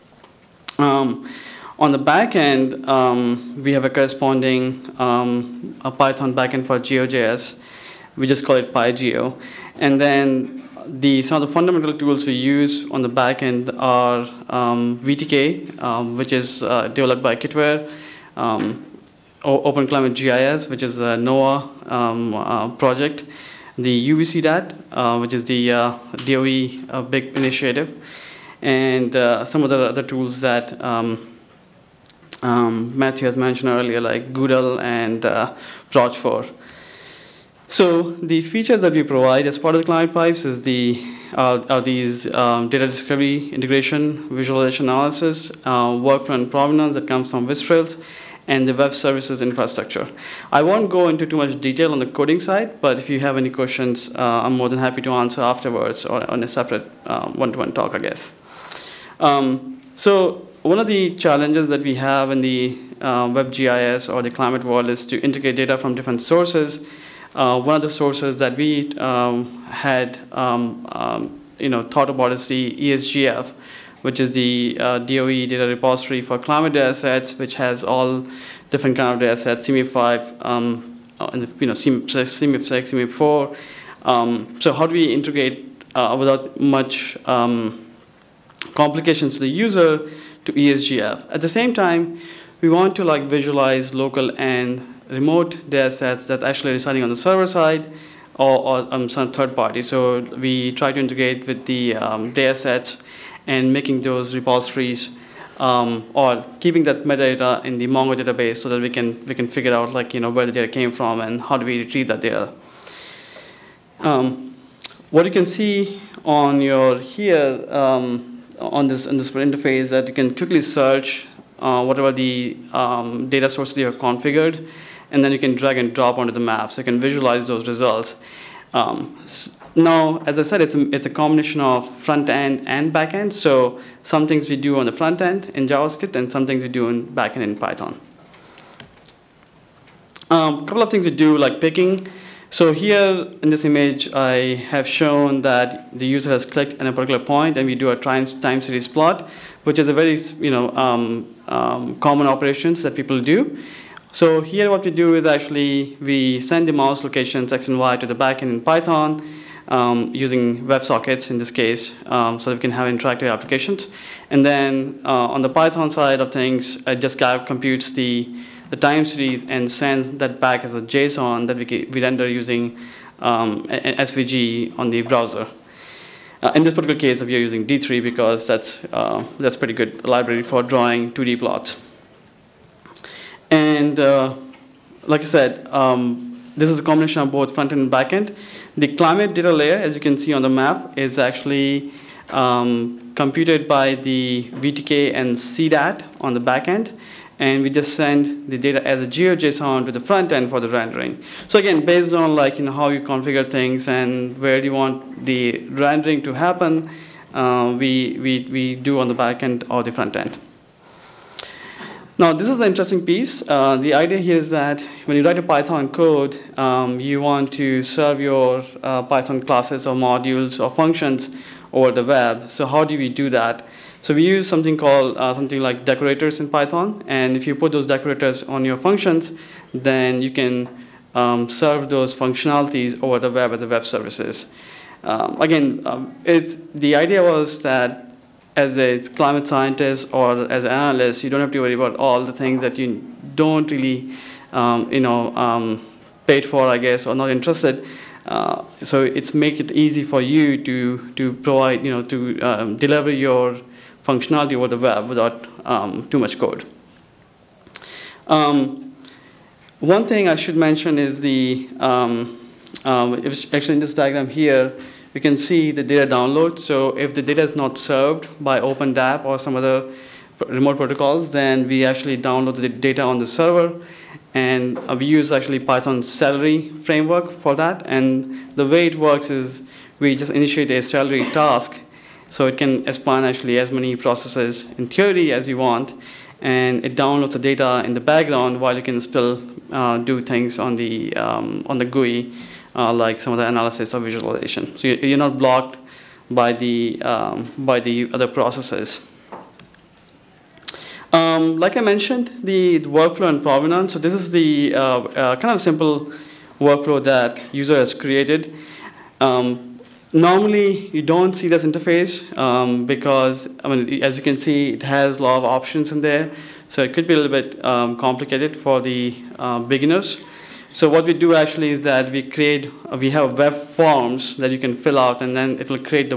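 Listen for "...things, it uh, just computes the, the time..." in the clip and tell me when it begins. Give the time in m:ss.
2:46.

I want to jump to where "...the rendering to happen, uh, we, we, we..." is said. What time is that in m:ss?
3:25.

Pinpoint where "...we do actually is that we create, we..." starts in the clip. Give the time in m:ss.
5:21.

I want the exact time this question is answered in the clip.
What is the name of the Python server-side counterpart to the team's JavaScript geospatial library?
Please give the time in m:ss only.
0:08.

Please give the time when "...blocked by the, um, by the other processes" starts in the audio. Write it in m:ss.
4:55.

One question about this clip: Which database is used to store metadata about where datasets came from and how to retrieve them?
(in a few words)
Mongo.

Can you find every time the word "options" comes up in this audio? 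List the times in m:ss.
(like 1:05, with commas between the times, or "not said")
5:15.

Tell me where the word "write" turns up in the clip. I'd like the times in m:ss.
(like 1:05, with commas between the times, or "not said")
3:35.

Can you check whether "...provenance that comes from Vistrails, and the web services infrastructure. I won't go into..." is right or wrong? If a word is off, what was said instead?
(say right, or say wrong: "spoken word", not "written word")
right.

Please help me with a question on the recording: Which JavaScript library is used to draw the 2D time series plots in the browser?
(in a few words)
D3.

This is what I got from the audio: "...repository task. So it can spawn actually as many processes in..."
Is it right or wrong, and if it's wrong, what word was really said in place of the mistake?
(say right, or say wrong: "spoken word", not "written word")
wrong: "celery", not "repository".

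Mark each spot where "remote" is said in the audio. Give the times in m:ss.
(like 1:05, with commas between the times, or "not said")
1:35, 4:30.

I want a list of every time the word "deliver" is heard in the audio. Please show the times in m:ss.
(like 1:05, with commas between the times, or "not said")
4:12.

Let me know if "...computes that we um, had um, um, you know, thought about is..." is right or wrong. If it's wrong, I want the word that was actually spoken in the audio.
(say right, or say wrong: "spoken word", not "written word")
wrong: "sources", not "computes".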